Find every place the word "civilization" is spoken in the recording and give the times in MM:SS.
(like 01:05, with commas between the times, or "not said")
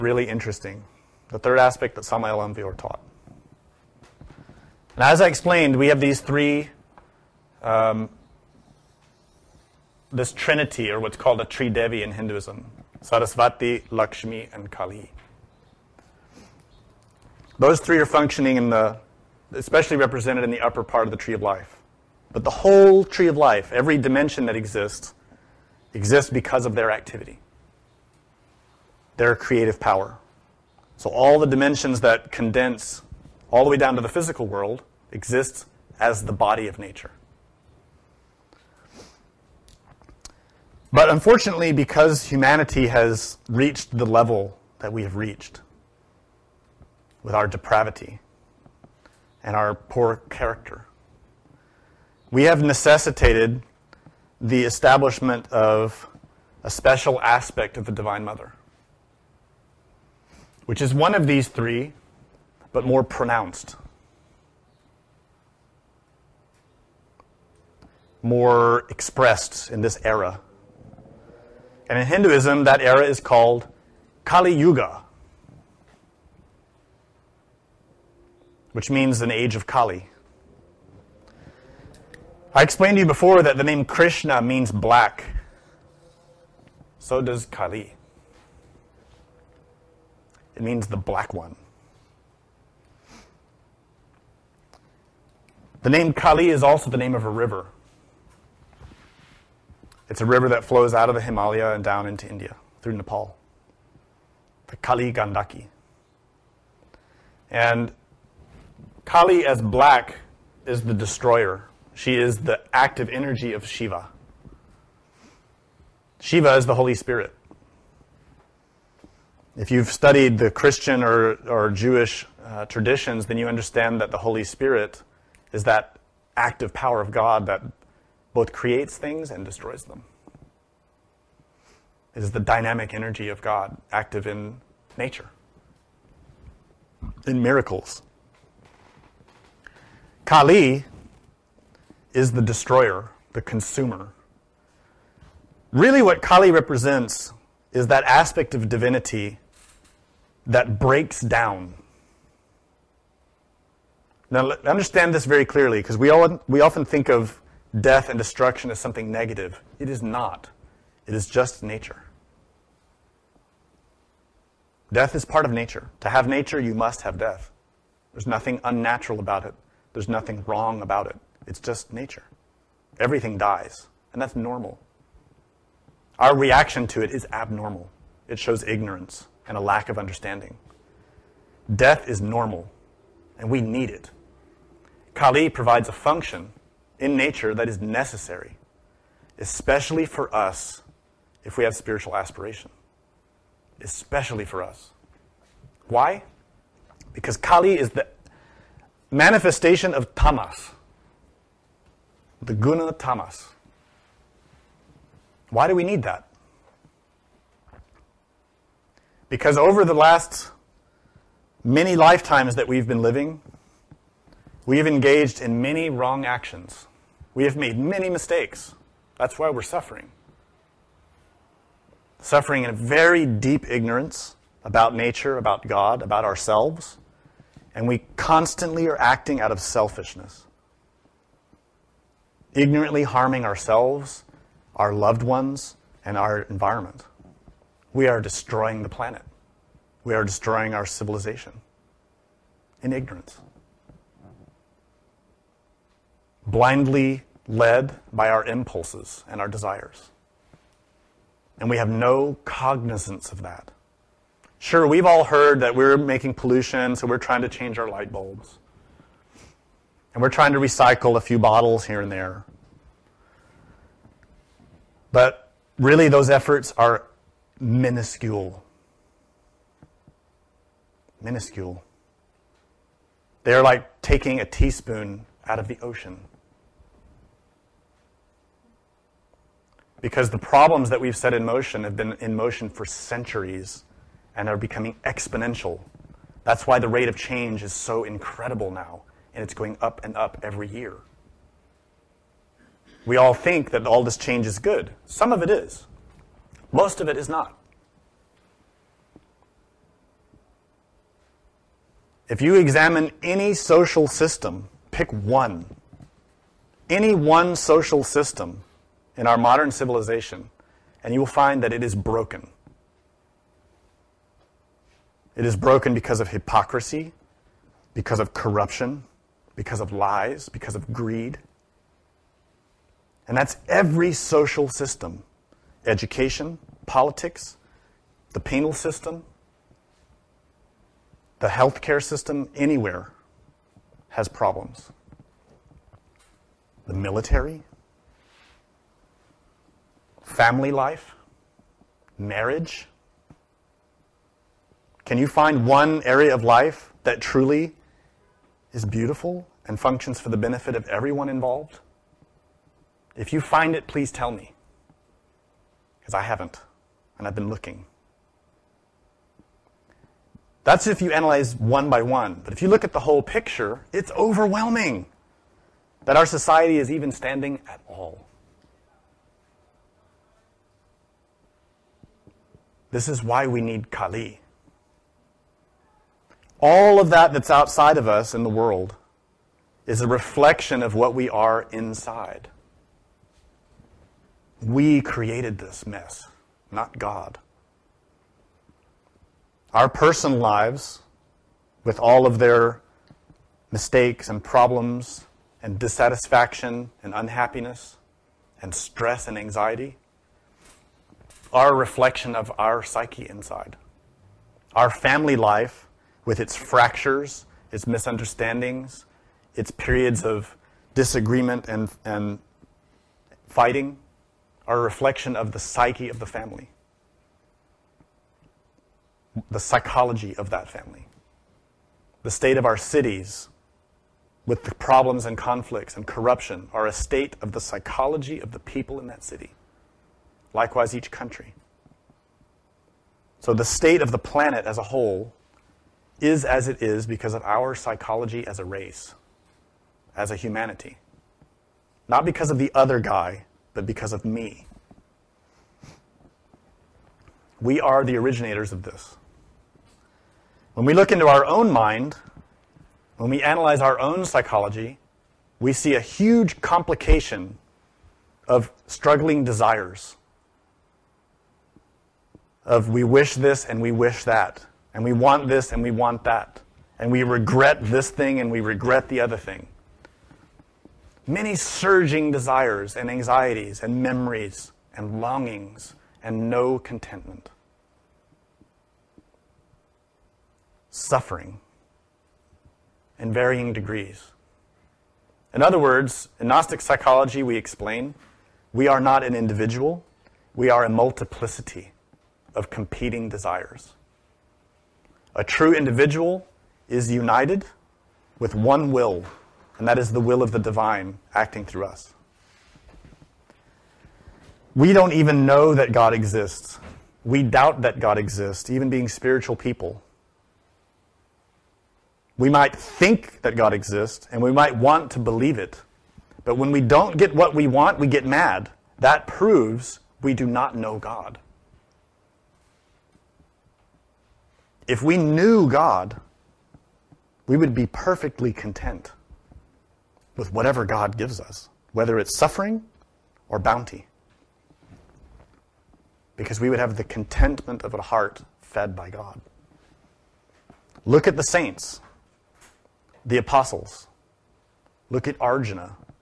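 04:00, 05:09.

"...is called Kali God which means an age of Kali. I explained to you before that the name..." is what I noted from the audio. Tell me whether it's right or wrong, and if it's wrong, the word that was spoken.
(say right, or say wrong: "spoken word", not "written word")
wrong: "Yuga", not "God".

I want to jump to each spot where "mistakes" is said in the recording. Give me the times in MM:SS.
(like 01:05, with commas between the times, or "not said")
03:38, 06:33.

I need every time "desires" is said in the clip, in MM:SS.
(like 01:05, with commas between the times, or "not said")
04:09, 07:39, 07:52, 08:13.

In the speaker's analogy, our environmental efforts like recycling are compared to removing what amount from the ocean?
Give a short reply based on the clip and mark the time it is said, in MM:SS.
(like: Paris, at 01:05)
A teaspoon, at 04:34.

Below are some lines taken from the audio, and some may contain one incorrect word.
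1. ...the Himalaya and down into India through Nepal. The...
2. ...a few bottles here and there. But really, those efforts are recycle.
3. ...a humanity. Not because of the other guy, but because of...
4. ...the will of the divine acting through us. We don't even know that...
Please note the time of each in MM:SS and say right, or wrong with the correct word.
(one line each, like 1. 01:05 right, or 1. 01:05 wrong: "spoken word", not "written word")
1. 01:41 right
2. 04:21 wrong: "minuscule", not "recycle"
3. 07:20 right
4. 08:20 right.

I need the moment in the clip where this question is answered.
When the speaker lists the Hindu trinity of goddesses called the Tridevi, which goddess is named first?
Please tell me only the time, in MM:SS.
00:13.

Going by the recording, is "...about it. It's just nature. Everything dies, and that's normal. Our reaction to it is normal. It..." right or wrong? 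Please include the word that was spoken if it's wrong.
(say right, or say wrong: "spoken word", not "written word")
wrong: "abnormal", not "normal".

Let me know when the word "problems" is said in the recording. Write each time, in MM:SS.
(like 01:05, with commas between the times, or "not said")
04:40, 05:34, 06:34, 07:04.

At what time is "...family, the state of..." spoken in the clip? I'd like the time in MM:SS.
07:00.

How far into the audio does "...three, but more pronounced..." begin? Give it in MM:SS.
01:01.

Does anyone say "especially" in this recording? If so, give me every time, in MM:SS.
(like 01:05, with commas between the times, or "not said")
00:19, 03:09, 03:13.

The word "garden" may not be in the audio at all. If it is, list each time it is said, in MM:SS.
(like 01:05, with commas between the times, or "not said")
not said.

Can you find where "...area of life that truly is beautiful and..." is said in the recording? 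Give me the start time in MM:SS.
05:46.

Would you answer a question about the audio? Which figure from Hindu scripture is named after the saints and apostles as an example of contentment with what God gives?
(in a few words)
Arjuna.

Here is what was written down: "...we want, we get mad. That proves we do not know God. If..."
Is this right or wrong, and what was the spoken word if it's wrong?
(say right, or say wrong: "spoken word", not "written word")
right.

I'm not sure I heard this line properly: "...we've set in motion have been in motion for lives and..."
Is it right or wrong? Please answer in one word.
wrong.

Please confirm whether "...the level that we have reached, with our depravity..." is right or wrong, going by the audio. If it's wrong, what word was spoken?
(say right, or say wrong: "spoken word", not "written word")
right.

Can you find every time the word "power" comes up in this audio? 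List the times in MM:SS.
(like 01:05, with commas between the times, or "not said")
00:29, 02:06.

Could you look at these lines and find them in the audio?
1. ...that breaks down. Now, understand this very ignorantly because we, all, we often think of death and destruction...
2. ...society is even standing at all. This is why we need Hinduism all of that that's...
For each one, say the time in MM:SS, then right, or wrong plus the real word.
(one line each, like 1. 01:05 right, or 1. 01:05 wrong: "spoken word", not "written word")
1. 02:30 wrong: "clearly", not "ignorantly"
2. 06:06 wrong: "Kali", not "Hinduism".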